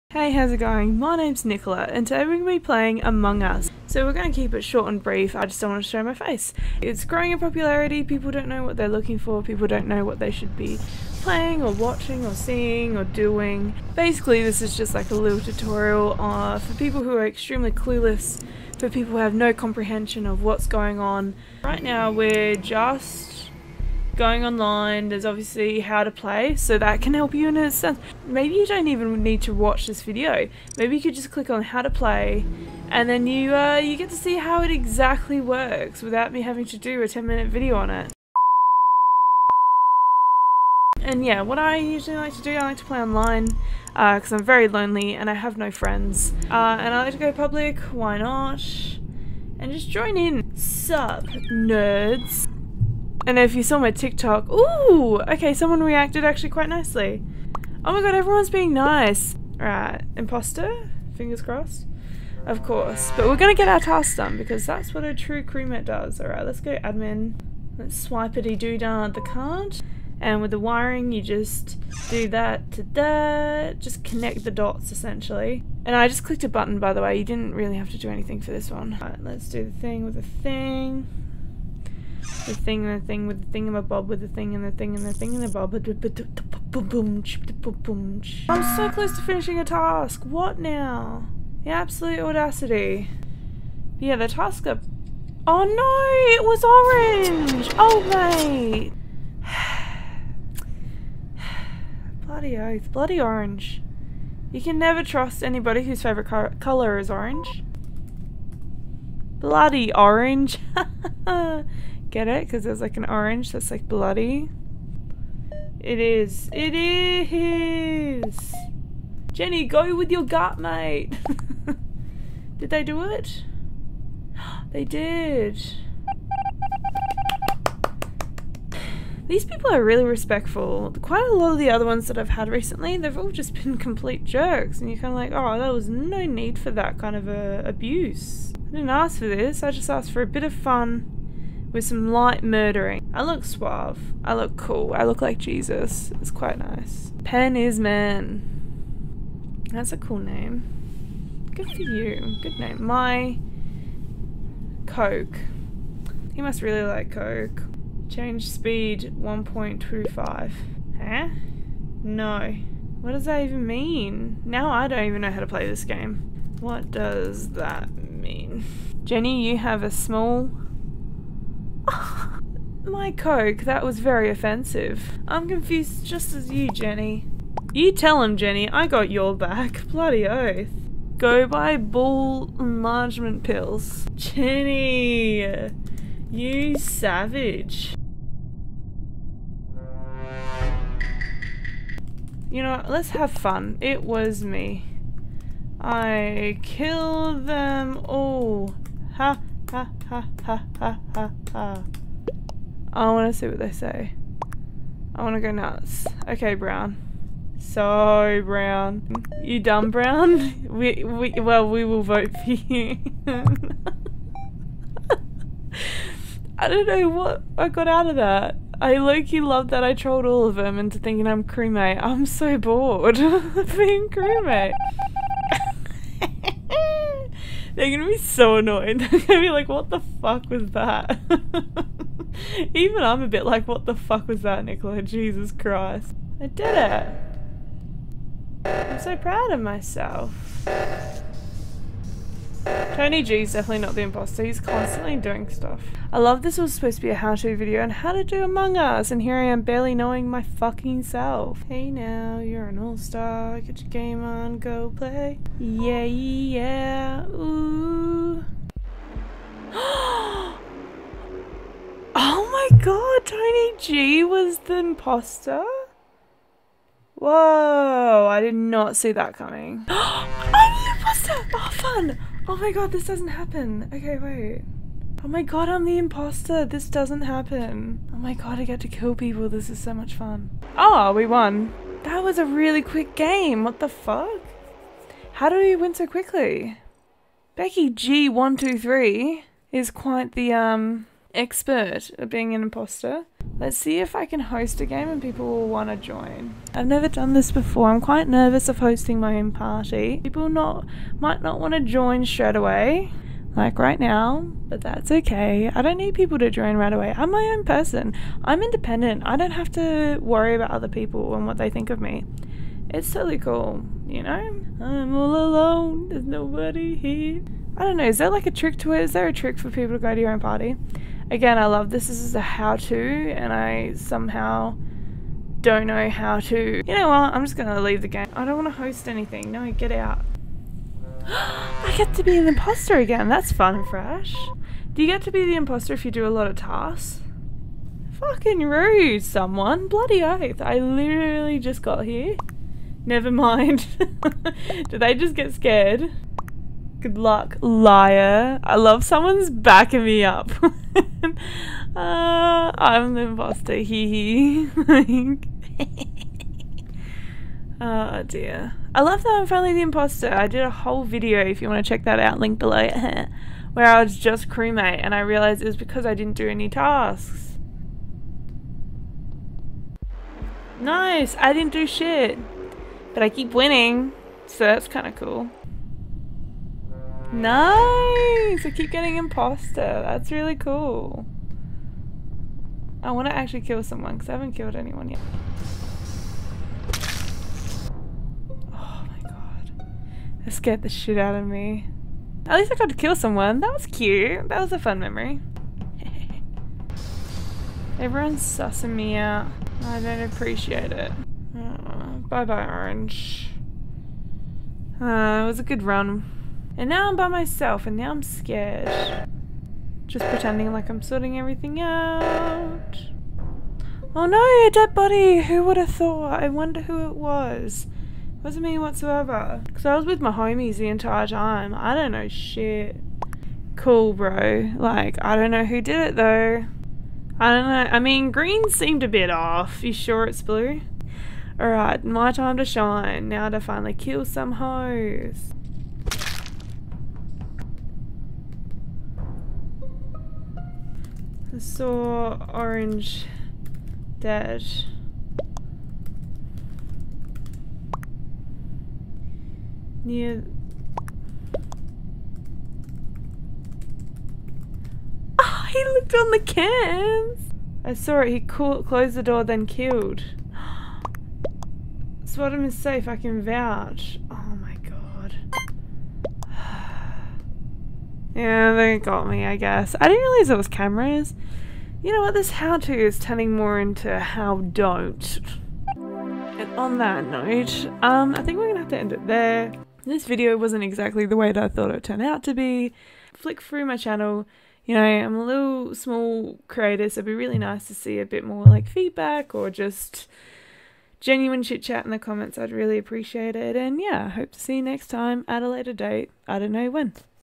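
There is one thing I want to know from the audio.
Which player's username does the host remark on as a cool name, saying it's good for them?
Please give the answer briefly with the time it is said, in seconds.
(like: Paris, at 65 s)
Pen is man, at 147 s.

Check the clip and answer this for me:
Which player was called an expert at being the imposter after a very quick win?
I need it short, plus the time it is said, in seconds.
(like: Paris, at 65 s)
Becky G123, at 287 s.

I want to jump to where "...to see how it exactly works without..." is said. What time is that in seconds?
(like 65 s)
34 s.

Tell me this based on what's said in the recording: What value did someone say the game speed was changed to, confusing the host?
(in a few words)
1.25.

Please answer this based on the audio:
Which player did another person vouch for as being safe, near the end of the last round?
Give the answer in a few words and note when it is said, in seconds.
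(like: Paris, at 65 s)
Swadham, at 462 s.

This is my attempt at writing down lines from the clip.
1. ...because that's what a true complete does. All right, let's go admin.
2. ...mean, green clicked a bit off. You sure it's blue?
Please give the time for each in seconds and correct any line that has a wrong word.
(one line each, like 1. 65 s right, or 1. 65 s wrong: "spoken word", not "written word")
1. 64 s wrong: "crewmate", not "complete"
2. 427 s wrong: "seemed", not "clicked".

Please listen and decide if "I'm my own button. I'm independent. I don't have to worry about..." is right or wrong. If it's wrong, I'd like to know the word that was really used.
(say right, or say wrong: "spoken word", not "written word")
wrong: "person", not "button".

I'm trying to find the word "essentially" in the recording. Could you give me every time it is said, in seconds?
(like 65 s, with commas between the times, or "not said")
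74 s.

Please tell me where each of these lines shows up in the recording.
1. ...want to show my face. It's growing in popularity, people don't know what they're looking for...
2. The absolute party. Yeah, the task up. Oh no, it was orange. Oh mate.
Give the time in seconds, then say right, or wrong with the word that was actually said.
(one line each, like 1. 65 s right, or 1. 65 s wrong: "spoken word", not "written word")
1. 5 s right
2. 91 s wrong: "audacity", not "party".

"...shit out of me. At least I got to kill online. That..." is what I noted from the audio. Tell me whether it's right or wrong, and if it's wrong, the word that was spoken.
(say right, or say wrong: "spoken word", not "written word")
wrong: "someone", not "online".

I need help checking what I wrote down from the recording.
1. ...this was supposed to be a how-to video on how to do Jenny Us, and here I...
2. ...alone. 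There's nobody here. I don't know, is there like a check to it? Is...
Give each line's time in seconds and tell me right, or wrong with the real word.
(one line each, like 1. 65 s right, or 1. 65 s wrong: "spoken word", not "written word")
1. 246 s wrong: "Among", not "Jenny"
2. 315 s wrong: "trick", not "check".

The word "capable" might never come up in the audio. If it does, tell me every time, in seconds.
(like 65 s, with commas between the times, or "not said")
not said.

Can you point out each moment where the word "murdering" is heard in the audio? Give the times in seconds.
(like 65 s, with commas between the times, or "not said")
142 s.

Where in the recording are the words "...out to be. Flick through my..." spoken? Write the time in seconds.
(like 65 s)
482 s.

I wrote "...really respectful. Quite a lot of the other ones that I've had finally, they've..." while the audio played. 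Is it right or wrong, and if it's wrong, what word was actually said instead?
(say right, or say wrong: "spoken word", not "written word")
wrong: "recently", not "finally".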